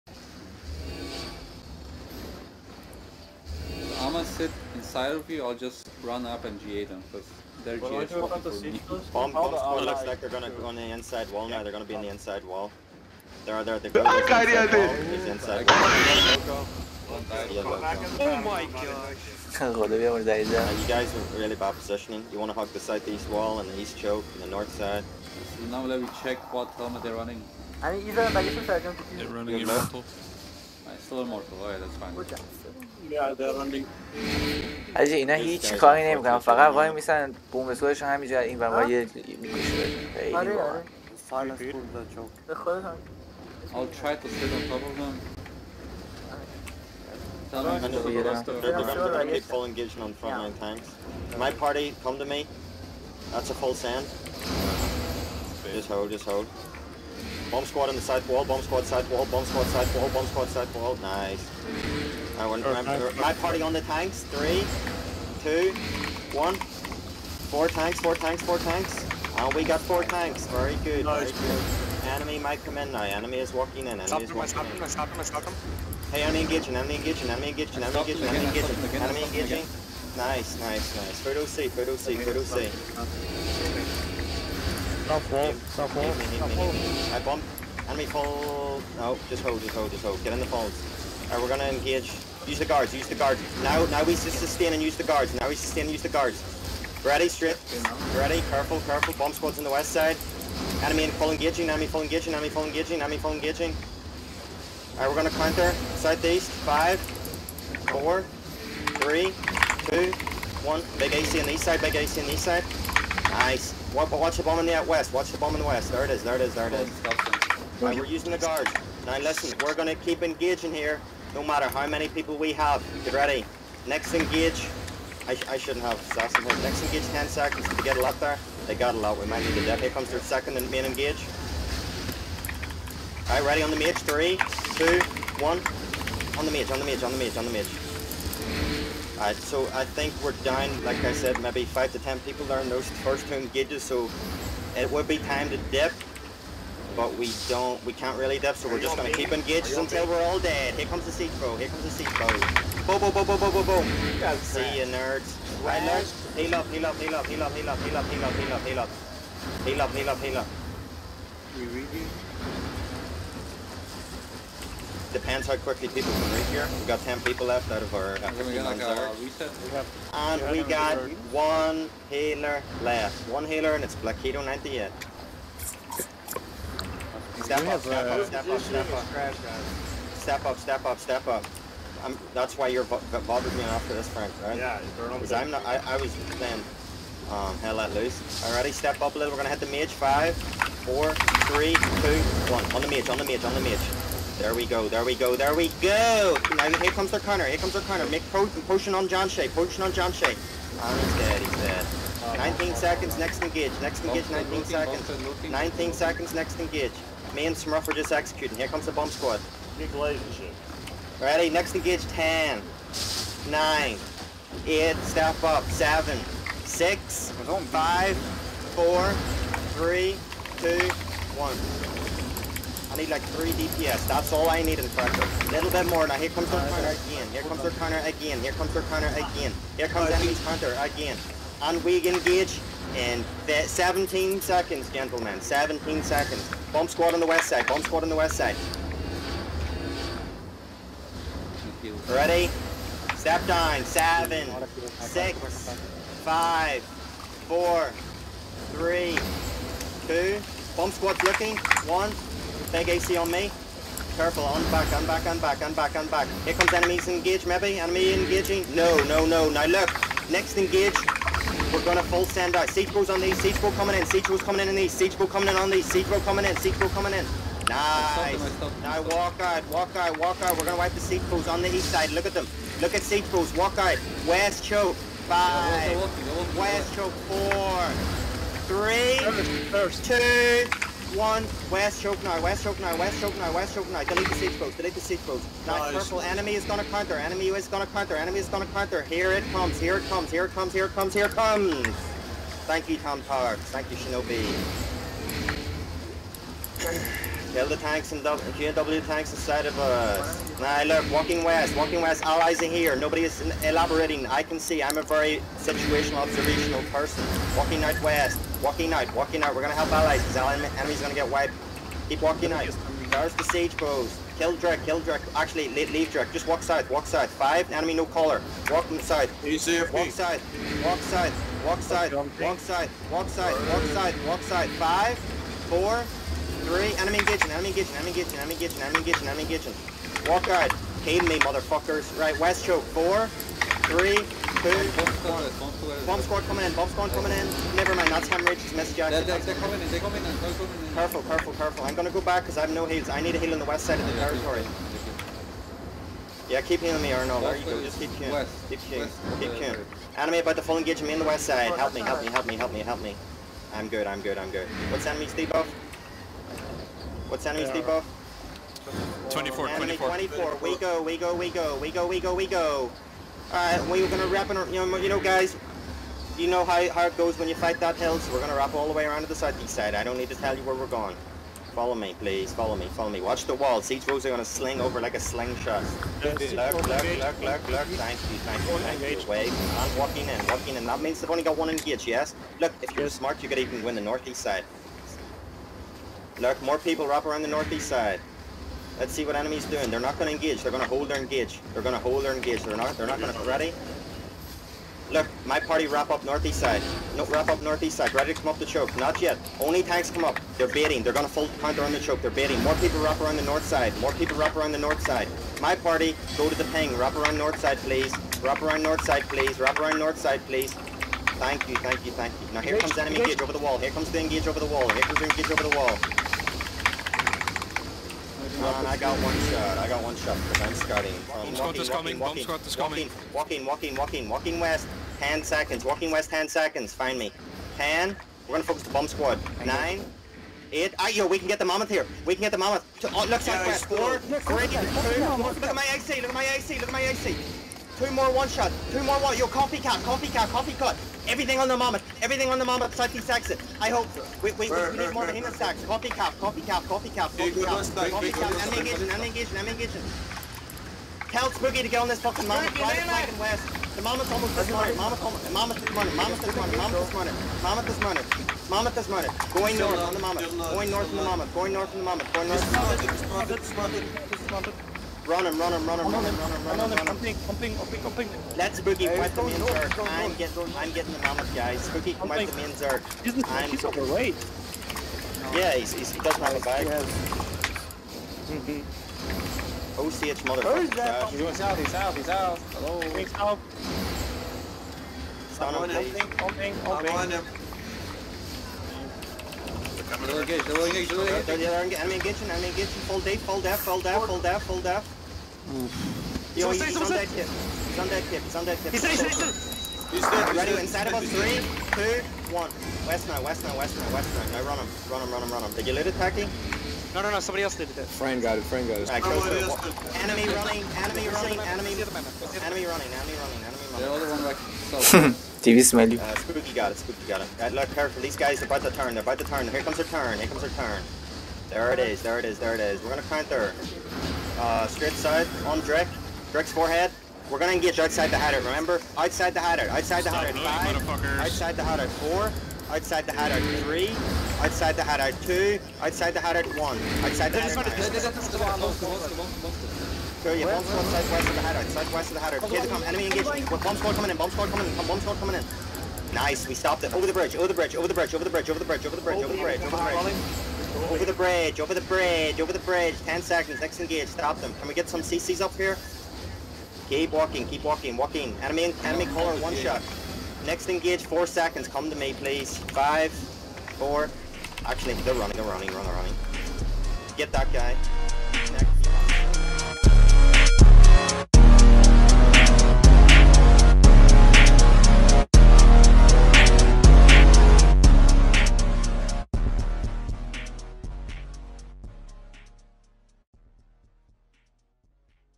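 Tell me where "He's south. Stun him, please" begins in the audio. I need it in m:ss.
8:03.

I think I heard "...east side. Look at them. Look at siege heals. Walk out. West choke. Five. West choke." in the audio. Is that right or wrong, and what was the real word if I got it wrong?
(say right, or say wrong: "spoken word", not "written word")
wrong: "balls", not "heals".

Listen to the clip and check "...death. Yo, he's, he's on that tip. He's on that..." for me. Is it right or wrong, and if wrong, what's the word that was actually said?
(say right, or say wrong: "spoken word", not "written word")
right.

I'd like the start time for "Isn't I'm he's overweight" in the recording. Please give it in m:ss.
7:53.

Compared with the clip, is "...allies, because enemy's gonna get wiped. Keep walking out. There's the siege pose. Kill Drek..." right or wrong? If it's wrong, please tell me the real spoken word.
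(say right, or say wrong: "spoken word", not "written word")
right.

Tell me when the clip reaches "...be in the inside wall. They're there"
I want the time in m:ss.
0:11.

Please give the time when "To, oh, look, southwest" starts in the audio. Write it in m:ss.
7:13.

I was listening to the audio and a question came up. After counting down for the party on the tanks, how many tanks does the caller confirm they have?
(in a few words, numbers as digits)
4.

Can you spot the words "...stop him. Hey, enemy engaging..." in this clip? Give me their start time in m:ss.
1:15.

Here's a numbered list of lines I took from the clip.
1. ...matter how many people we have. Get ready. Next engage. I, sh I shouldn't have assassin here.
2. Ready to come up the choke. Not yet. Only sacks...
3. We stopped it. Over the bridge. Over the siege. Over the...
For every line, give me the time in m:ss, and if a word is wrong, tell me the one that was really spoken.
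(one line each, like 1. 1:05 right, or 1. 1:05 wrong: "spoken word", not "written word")
1. 2:01 right
2. 6:38 wrong: "tanks", not "sacks"
3. 9:06 wrong: "bridge", not "siege".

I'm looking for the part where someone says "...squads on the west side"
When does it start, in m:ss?
1:39.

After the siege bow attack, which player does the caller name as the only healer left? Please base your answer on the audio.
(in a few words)
Blackito 98.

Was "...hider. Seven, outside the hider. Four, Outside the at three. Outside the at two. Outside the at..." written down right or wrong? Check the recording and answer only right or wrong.
wrong.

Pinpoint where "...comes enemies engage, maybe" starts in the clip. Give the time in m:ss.
4:16.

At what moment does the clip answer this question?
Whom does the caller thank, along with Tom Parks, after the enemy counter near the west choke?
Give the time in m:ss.
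4:53.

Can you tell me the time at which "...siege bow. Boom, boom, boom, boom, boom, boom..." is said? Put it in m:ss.
2:31.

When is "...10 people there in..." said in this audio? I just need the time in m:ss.
2:21.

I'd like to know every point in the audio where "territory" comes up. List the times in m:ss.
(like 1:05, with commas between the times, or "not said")
5:44.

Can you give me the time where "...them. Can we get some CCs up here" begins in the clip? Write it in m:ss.
9:14.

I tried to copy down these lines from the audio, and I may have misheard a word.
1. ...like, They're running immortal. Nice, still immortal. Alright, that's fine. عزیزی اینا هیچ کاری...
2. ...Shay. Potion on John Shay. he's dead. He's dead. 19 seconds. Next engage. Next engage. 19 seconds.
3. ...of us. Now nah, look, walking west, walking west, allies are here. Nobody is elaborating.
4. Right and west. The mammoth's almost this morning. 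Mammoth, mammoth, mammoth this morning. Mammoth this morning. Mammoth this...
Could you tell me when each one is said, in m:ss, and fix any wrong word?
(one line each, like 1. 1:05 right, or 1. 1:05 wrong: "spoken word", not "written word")
1. 0:28 right
2. 3:19 right
3. 4:59 right
4. 7:32 right.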